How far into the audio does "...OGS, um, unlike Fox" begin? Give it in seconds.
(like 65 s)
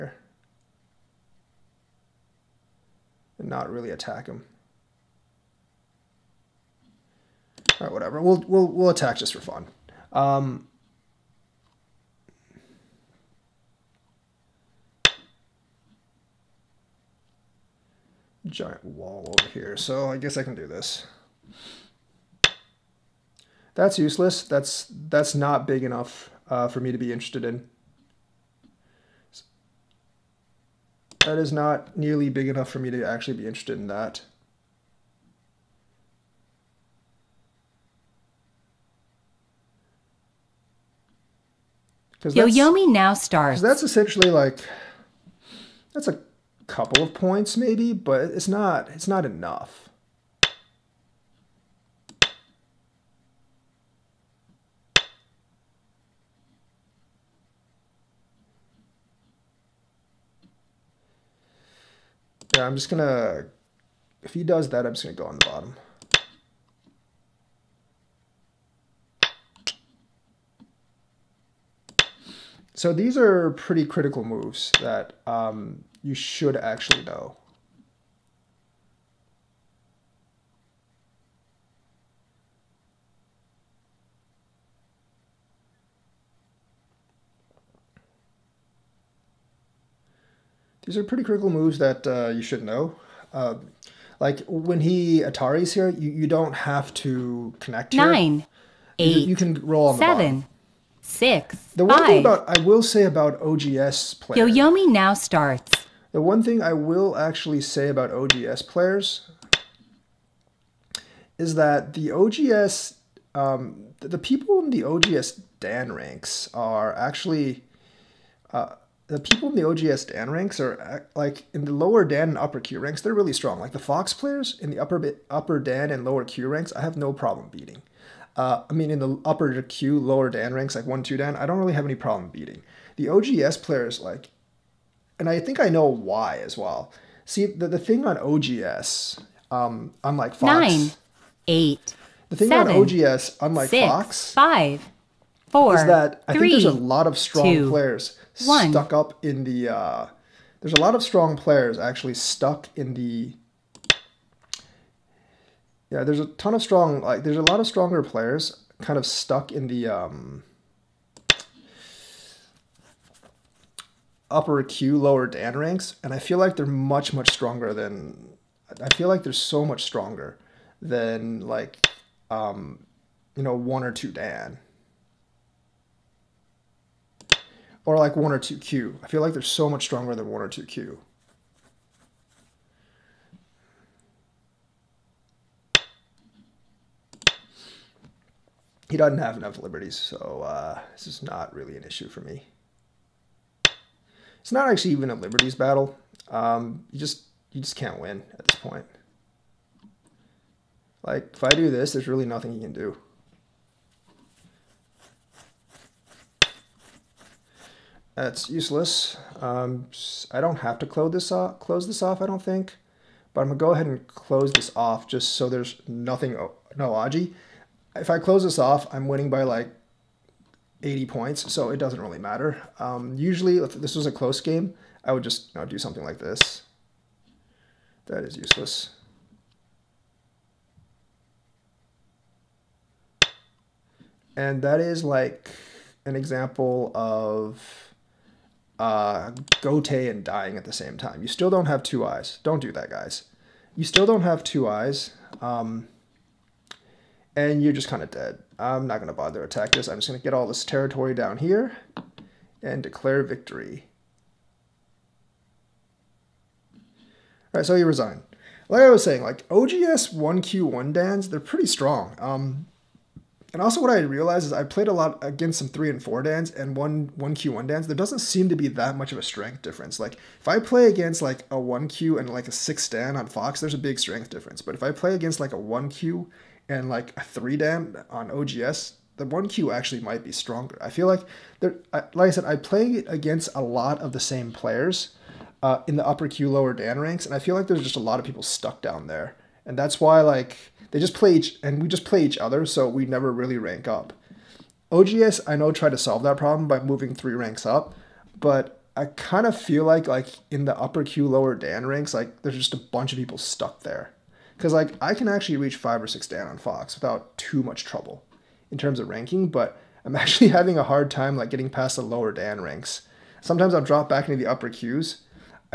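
138 s.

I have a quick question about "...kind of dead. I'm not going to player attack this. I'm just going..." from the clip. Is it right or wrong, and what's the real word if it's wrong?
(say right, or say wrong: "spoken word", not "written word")
wrong: "bother", not "player".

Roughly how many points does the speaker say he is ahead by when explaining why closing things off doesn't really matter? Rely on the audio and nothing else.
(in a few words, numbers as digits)
80.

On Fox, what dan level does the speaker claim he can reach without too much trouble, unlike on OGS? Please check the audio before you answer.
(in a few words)
5 or 6 dan.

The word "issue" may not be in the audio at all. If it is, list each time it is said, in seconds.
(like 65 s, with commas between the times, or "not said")
191 s.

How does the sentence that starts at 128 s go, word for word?
Uh, I mean, in the upper kyu, lower Dan ranks, like 1, 2 Dan, I don't really have any problem beating.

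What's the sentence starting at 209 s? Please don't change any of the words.
Um, I don't have to close this off, close this off, I don't think.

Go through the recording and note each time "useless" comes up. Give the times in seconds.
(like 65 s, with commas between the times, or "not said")
23 s, 208 s, 228 s.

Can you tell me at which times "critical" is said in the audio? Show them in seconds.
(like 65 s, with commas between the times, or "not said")
73 s, 91 s.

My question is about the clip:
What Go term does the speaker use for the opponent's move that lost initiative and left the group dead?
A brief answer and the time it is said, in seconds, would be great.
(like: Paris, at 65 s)
Gotei, at 239 s.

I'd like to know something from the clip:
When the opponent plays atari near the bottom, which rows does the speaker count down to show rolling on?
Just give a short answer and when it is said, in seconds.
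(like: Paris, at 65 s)
7, 6, at 99 s.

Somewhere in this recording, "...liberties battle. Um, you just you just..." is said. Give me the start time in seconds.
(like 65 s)
195 s.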